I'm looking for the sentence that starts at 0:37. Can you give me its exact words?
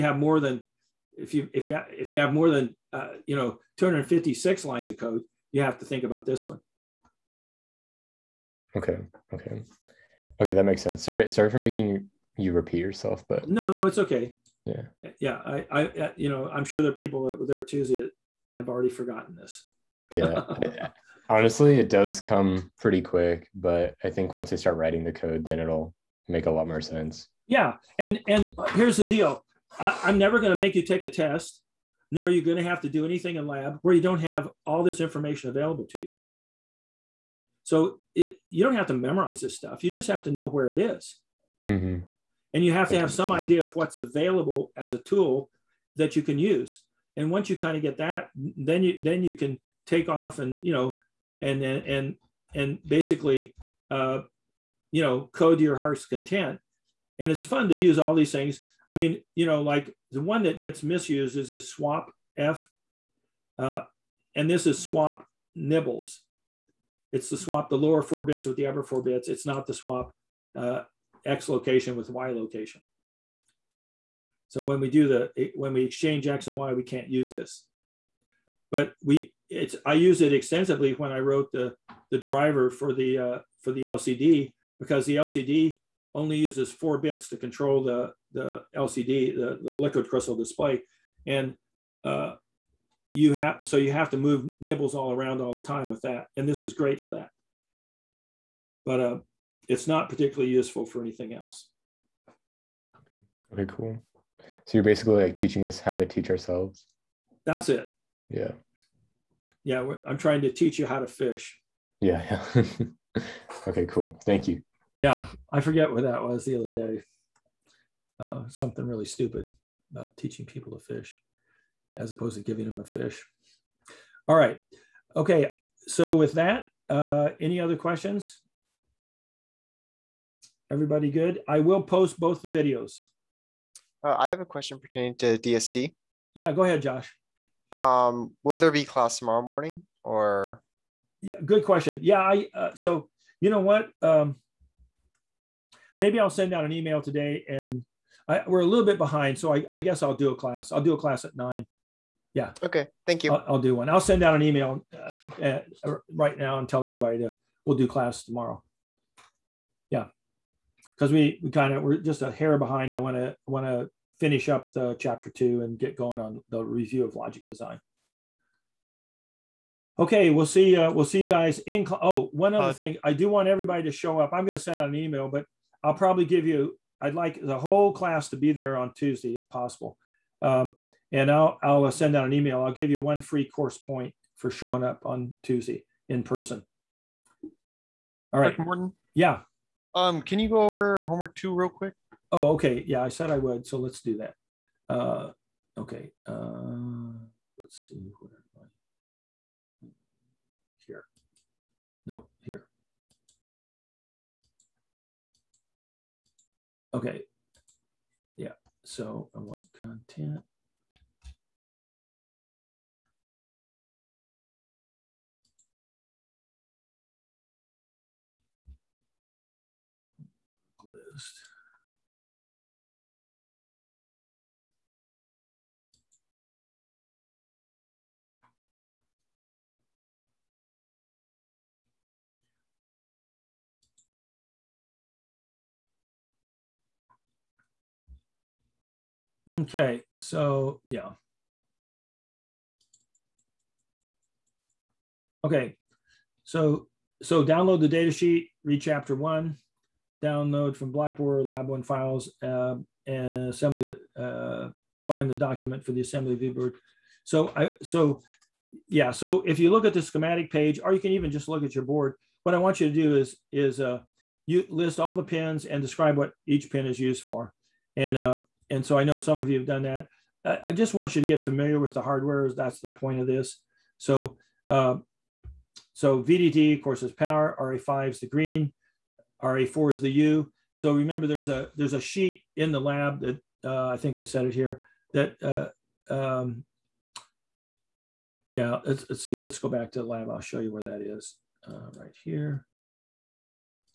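So it, you don't have to memorize this stuff.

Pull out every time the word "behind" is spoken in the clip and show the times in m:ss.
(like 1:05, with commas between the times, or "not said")
2:28, 2:42.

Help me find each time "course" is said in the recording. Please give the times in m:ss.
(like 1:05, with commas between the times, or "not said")
3:03, 4:36.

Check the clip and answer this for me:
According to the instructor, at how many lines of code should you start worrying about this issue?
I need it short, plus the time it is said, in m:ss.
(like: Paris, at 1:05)
256, at 0:03.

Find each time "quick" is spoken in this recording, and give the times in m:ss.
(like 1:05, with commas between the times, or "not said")
0:23, 3:11.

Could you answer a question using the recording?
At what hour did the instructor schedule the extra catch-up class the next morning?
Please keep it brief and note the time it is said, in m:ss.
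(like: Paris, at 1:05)
9, at 2:31.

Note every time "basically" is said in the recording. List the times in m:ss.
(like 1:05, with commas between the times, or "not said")
0:52, 1:44.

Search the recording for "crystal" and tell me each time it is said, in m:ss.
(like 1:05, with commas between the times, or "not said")
1:30.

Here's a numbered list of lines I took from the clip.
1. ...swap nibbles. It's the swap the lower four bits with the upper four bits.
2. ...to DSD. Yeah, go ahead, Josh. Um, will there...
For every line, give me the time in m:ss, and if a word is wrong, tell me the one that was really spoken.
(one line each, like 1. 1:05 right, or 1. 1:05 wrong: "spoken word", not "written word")
1. 1:04 right
2. 2:15 right.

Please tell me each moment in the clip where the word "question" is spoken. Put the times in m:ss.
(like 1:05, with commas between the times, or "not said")
2:07, 2:14, 2:21.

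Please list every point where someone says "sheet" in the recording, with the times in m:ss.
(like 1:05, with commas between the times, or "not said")
4:08, 4:41.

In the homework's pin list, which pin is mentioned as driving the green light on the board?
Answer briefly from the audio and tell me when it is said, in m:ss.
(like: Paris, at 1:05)
RA5, at 4:37.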